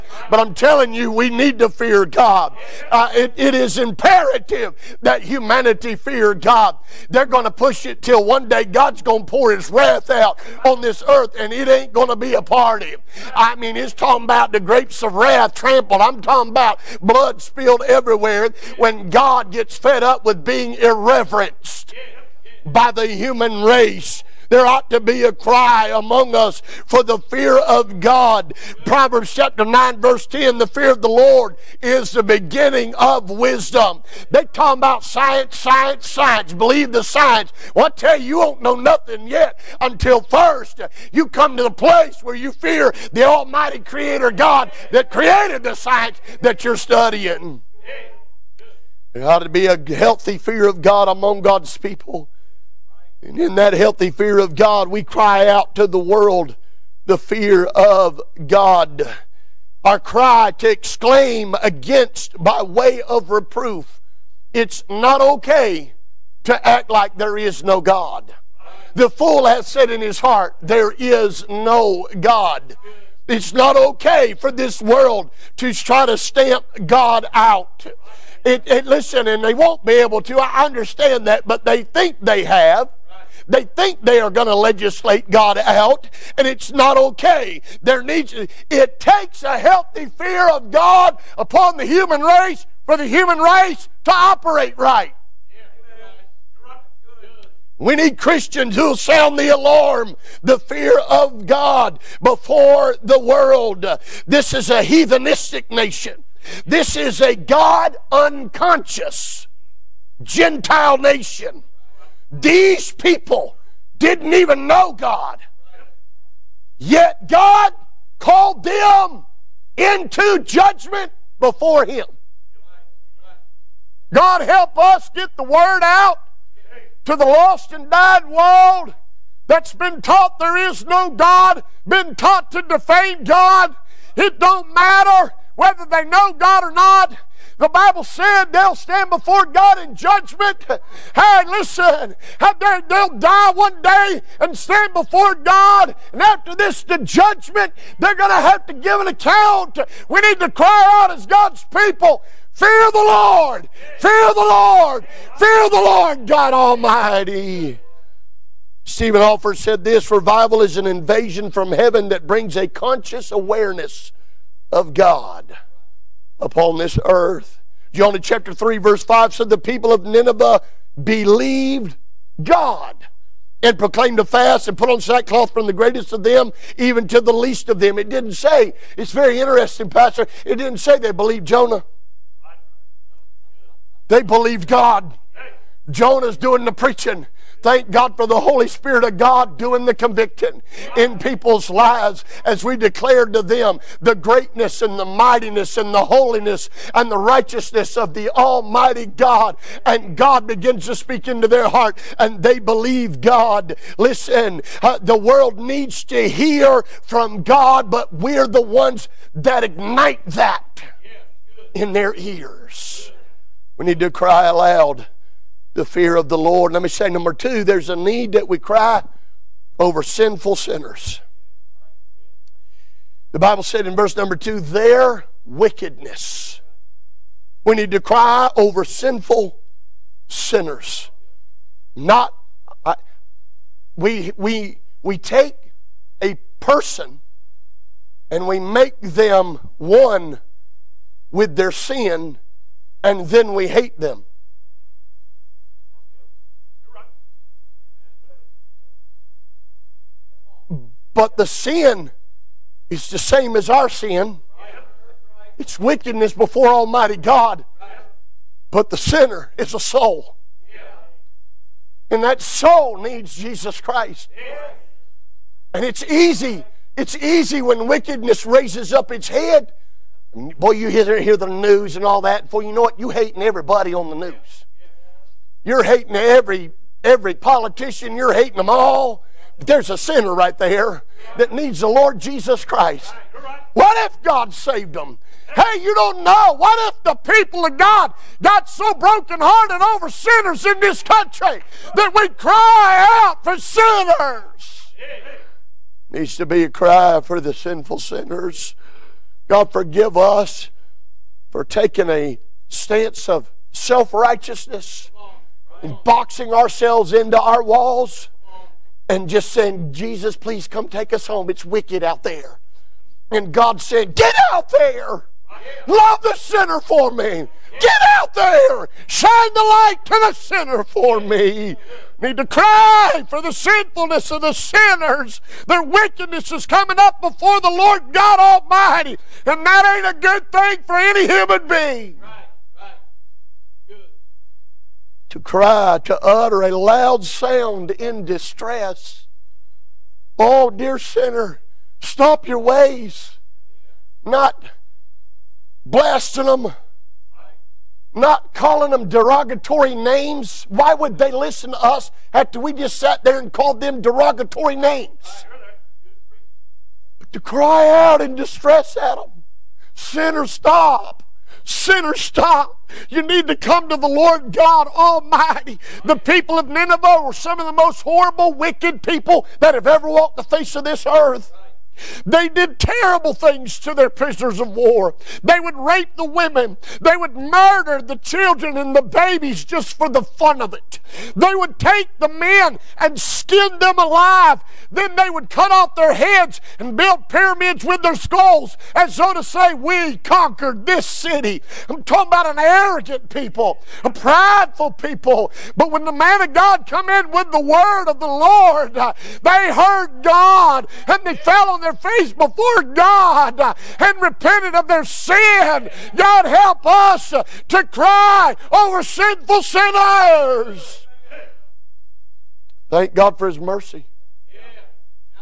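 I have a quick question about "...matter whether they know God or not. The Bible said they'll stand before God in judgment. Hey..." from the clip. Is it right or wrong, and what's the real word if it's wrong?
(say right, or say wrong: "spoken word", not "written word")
right.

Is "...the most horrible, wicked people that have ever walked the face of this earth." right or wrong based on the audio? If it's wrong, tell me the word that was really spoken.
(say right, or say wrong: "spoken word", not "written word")
right.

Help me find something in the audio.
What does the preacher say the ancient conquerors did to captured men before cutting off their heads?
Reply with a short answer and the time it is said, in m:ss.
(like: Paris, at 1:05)
skin them alive, at 6:23.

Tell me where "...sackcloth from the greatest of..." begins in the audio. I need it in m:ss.
2:55.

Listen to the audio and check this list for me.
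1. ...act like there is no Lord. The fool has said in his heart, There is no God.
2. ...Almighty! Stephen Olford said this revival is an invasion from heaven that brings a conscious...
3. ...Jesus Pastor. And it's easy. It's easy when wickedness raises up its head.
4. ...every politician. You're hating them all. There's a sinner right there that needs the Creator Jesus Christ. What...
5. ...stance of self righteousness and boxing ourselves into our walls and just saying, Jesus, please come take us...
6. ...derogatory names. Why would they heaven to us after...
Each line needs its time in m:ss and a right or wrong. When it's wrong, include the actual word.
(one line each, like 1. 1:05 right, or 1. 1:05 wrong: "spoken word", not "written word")
1. 1:06 wrong: "God", not "Lord"
2. 2:36 right
3. 4:23 wrong: "Christ", not "Pastor"
4. 4:37 wrong: "Lord", not "Creator"
5. 5:02 right
6. 5:49 wrong: "listen", not "heaven".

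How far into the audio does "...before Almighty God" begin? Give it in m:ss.
4:16.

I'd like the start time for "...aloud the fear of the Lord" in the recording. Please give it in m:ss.
3:34.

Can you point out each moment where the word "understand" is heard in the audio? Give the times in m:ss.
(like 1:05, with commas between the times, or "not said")
1:20.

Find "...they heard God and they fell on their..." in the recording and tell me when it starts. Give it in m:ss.
6:38.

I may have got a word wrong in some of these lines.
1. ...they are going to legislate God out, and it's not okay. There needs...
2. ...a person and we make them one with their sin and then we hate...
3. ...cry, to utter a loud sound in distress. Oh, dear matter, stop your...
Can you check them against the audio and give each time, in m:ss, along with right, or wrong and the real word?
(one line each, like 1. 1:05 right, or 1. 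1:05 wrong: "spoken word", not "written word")
1. 1:24 right
2. 3:56 right
3. 5:35 wrong: "sinner", not "matter".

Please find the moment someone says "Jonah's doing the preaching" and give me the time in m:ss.
3:05.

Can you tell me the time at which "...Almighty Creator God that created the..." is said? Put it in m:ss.
0:43.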